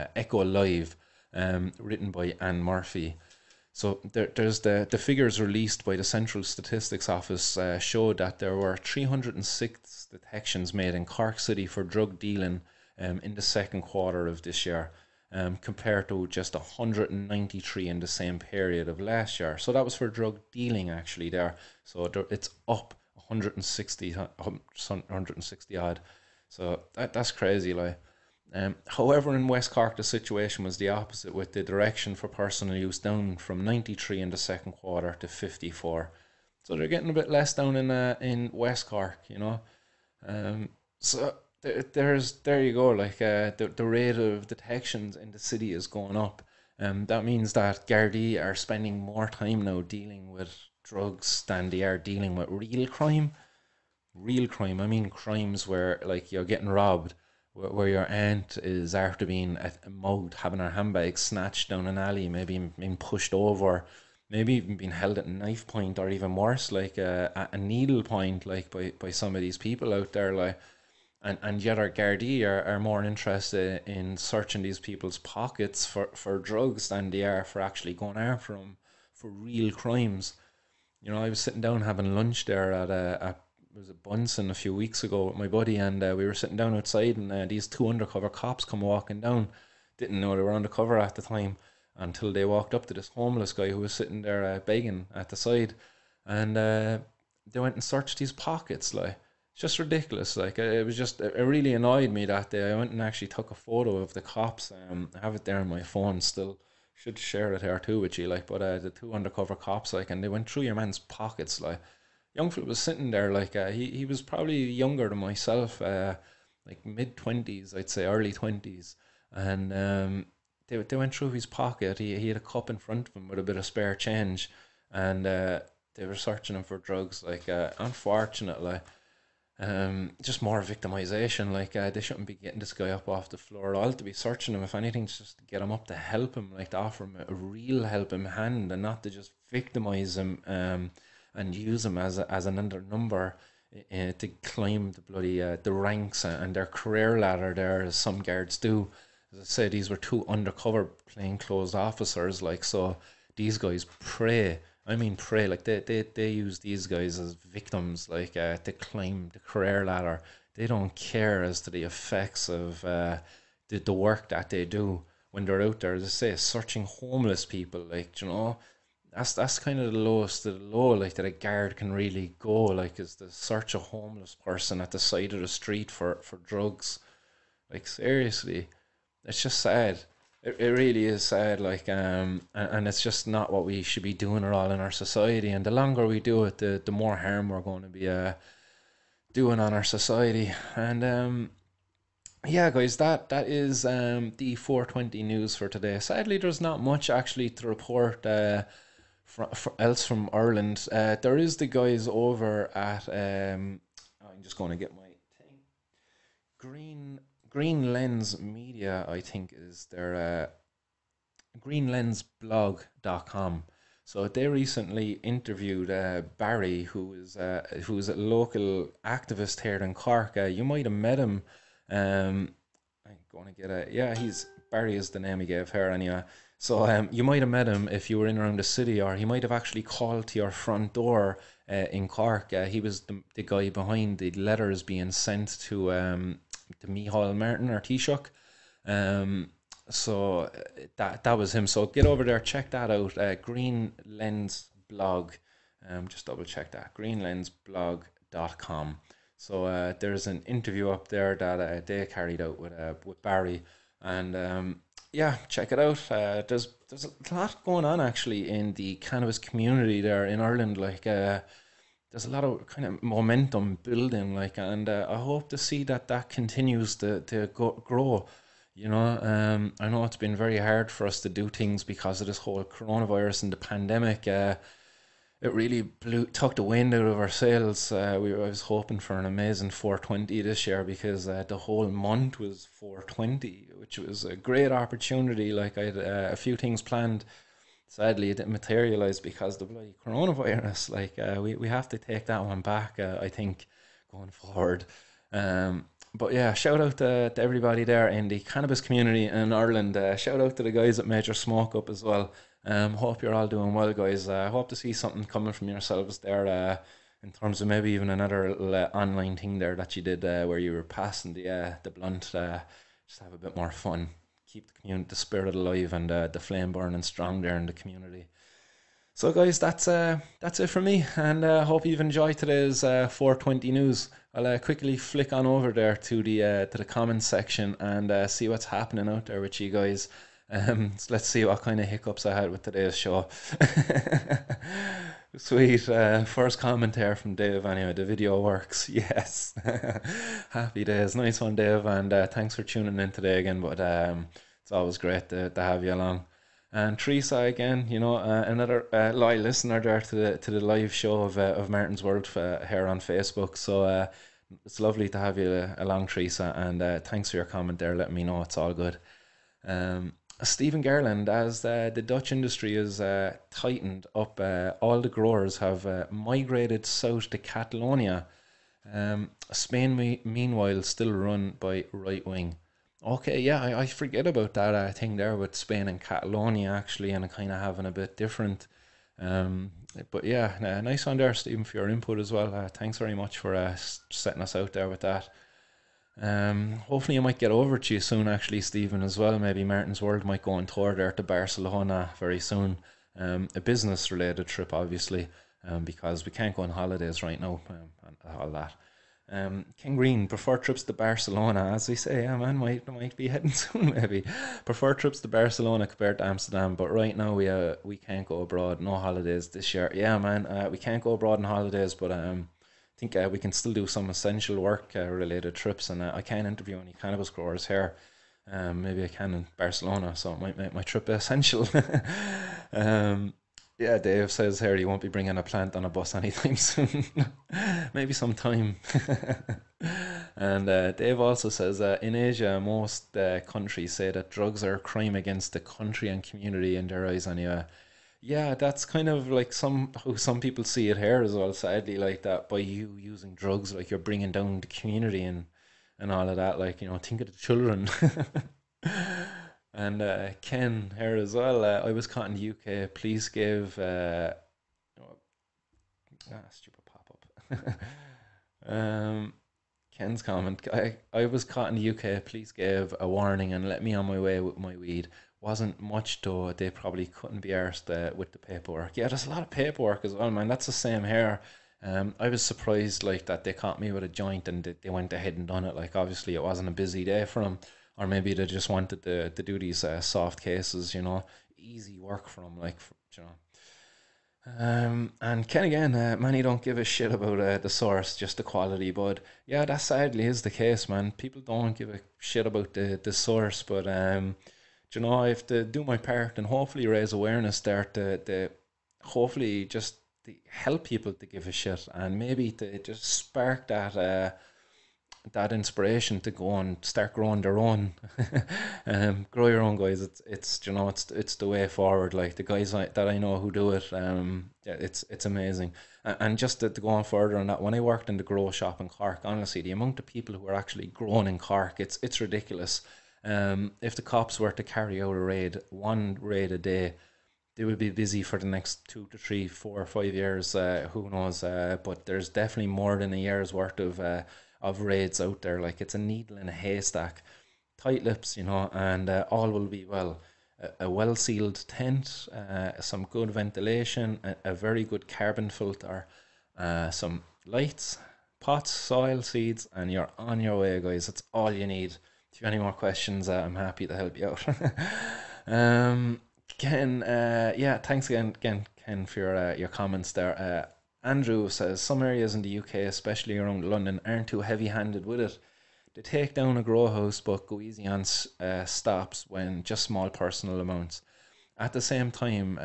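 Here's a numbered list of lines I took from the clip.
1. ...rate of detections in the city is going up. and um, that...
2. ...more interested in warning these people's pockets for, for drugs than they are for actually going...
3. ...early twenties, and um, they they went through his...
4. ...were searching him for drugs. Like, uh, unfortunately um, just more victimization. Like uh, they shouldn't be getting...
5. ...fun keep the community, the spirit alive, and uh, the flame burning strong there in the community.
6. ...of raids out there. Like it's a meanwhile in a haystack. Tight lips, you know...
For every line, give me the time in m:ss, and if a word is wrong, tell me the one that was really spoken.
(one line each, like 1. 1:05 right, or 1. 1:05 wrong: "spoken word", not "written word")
1. 0:43 right
2. 1:12 wrong: "searching", not "warning"
3. 1:58 right
4. 2:06 right
5. 5:13 right
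6. 8:54 wrong: "needle", not "meanwhile".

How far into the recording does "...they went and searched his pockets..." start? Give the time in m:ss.
1:37.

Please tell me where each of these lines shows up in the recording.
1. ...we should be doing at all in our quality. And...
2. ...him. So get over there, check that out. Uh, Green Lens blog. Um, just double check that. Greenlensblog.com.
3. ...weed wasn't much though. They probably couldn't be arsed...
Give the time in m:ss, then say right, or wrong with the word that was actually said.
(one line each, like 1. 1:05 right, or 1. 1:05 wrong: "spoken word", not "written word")
1. 3:03 wrong: "society", not "quality"
2. 4:01 right
3. 7:44 right.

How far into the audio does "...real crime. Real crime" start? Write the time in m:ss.
0:52.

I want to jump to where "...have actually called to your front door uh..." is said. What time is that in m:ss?
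3:49.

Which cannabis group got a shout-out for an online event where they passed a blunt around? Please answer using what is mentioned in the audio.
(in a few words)
Major Smoke Up.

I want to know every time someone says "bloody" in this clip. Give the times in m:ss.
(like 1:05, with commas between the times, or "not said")
2:25, 4:49.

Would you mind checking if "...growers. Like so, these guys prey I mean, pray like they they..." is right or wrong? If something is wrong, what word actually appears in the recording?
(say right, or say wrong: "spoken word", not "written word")
wrong: "officers", not "growers".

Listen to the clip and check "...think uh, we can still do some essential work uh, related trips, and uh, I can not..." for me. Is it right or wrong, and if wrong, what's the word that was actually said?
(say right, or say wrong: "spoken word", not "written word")
right.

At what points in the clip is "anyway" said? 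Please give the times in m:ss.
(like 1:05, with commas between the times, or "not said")
3:45, 5:37, 7:17.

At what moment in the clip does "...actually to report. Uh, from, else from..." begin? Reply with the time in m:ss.
3:17.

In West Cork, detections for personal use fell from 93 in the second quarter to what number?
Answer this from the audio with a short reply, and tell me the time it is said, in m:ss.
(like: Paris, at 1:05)
54, at 0:35.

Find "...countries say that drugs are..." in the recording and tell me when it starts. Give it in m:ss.
7:13.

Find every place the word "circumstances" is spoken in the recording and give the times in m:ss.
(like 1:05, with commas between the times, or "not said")
not said.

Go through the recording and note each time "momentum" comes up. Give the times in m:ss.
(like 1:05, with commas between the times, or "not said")
4:23.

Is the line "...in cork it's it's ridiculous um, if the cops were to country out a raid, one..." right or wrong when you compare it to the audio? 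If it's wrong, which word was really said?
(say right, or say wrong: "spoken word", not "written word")
wrong: "carry", not "country".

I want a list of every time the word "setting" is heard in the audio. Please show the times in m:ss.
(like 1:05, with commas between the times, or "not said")
6:24.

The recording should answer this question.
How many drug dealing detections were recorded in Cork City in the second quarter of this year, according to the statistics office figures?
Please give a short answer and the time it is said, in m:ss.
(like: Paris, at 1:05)
306, at 0:08.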